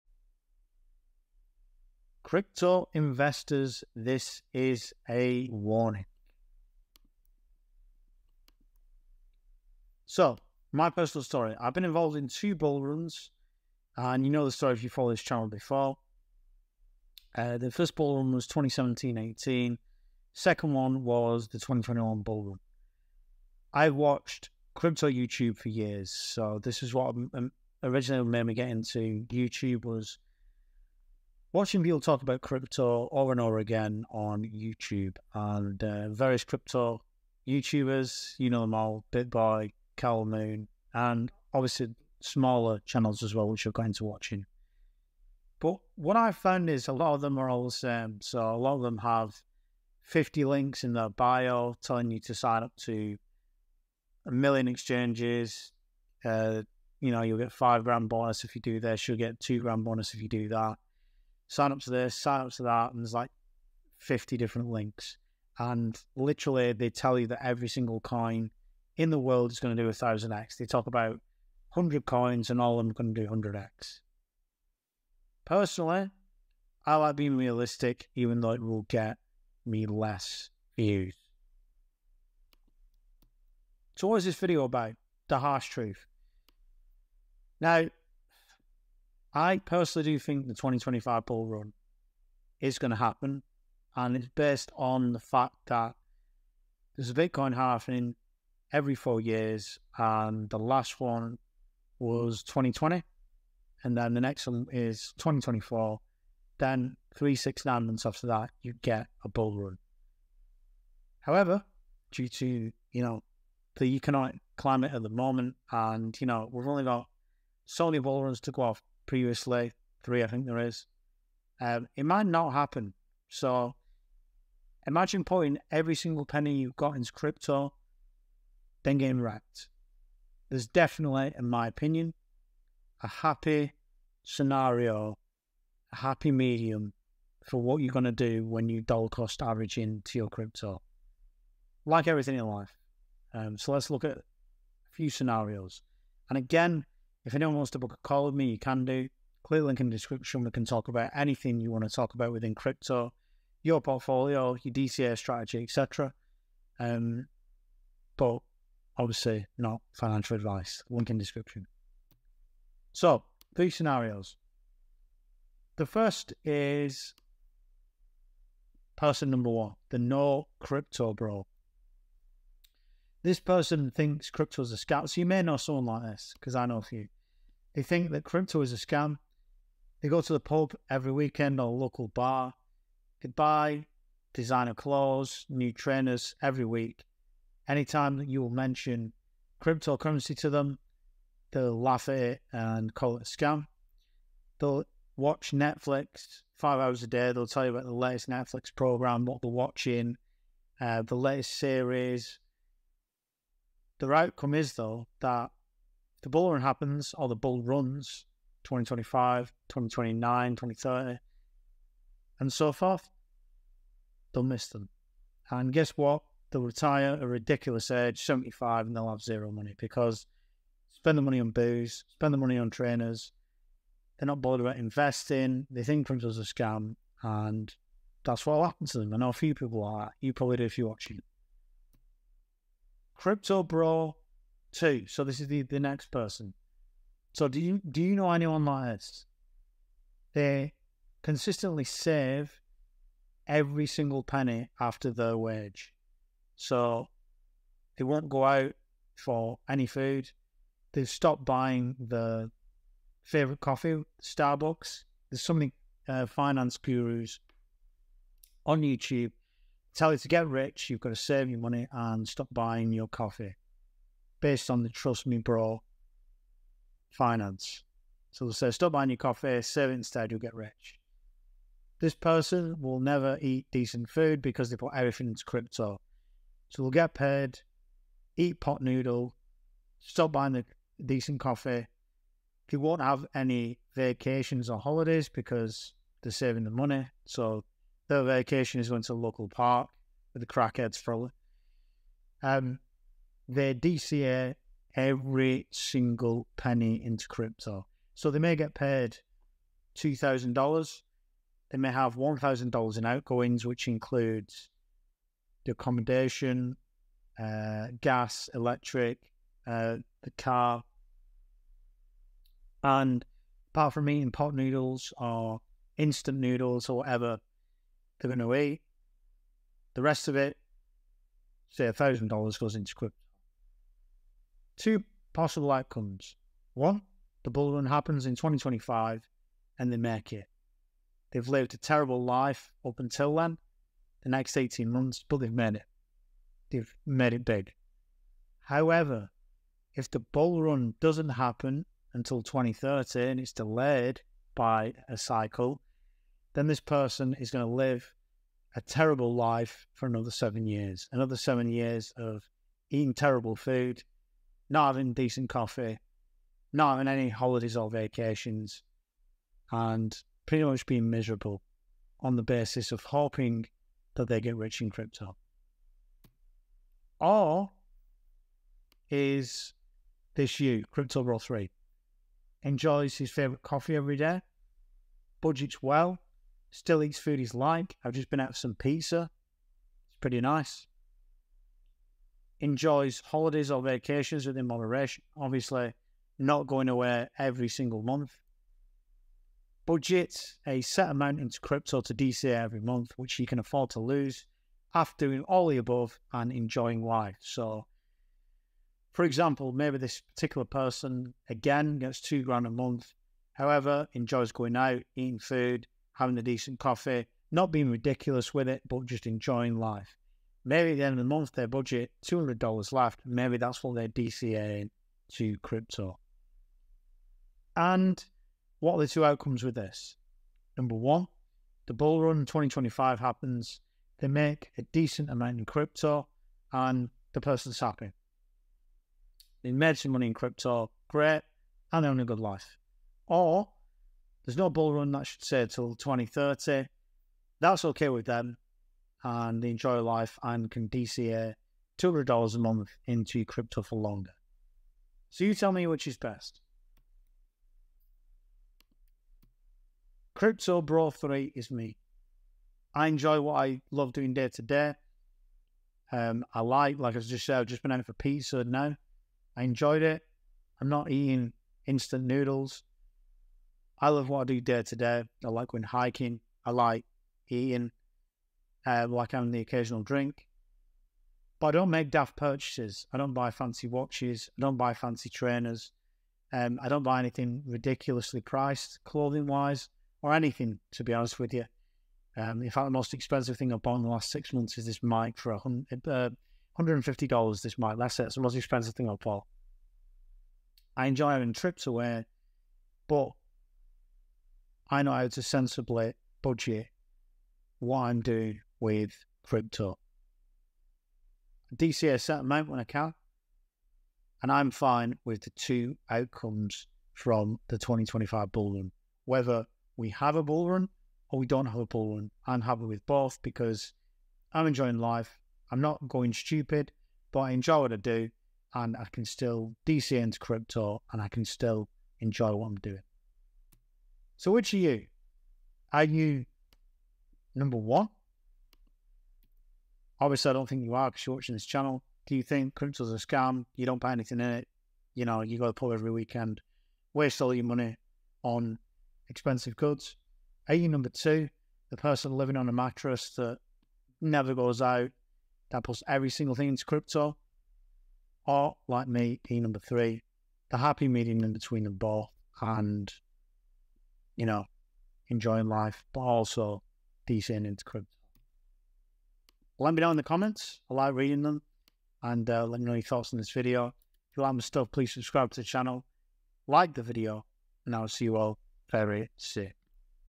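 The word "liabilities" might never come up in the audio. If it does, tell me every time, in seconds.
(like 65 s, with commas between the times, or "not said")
not said.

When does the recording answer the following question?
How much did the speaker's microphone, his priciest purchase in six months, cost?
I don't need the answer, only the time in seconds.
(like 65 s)
486 s.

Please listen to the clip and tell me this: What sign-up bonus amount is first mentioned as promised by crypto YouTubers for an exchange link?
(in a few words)
5 grand.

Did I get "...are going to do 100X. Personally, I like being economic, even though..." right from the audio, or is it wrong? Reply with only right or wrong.
wrong.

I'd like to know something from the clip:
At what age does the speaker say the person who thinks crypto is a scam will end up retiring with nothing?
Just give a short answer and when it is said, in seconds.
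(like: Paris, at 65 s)
75, at 218 s.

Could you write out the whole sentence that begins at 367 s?
Or is this you, Crypto Bro 3, enjoys his favorite coffee every day, budgets well, Still eats food he's like.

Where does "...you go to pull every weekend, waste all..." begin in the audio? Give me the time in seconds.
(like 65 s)
535 s.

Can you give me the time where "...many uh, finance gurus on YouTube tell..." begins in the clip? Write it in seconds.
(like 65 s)
255 s.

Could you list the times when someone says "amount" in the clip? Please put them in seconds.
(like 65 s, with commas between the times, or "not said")
391 s, 425 s, 502 s.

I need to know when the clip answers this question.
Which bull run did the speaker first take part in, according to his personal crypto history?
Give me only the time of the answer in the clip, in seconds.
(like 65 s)
18 s.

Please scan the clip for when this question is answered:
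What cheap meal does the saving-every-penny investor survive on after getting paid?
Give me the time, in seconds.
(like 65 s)
278 s.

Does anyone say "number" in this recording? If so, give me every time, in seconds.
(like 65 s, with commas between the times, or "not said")
169 s, 420 s, 527 s, 540 s, 549 s.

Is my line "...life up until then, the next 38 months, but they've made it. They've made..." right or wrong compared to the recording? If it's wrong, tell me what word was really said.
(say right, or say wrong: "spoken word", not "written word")
wrong: "18", not "38".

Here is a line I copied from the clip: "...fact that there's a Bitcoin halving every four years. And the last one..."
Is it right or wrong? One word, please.
right.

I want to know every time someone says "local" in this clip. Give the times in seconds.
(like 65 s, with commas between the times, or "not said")
181 s, 289 s.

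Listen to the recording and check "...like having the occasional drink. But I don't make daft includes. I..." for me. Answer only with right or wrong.
wrong.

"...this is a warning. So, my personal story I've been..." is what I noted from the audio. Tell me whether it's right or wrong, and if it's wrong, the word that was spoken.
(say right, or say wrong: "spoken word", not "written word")
right.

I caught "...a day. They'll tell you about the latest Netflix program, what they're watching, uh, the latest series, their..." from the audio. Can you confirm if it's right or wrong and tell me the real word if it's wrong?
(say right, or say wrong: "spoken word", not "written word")
right.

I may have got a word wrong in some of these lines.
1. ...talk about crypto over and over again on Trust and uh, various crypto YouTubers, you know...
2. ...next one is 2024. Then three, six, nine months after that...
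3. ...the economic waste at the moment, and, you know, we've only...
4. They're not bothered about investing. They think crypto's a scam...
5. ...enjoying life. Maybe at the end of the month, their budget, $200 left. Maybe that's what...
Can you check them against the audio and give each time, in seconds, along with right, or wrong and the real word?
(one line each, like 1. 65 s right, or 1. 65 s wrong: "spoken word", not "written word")
1. 31 s wrong: "YouTube", not "Trust"
2. 104 s right
3. 113 s wrong: "climate", not "waste"
4. 224 s right
5. 409 s right.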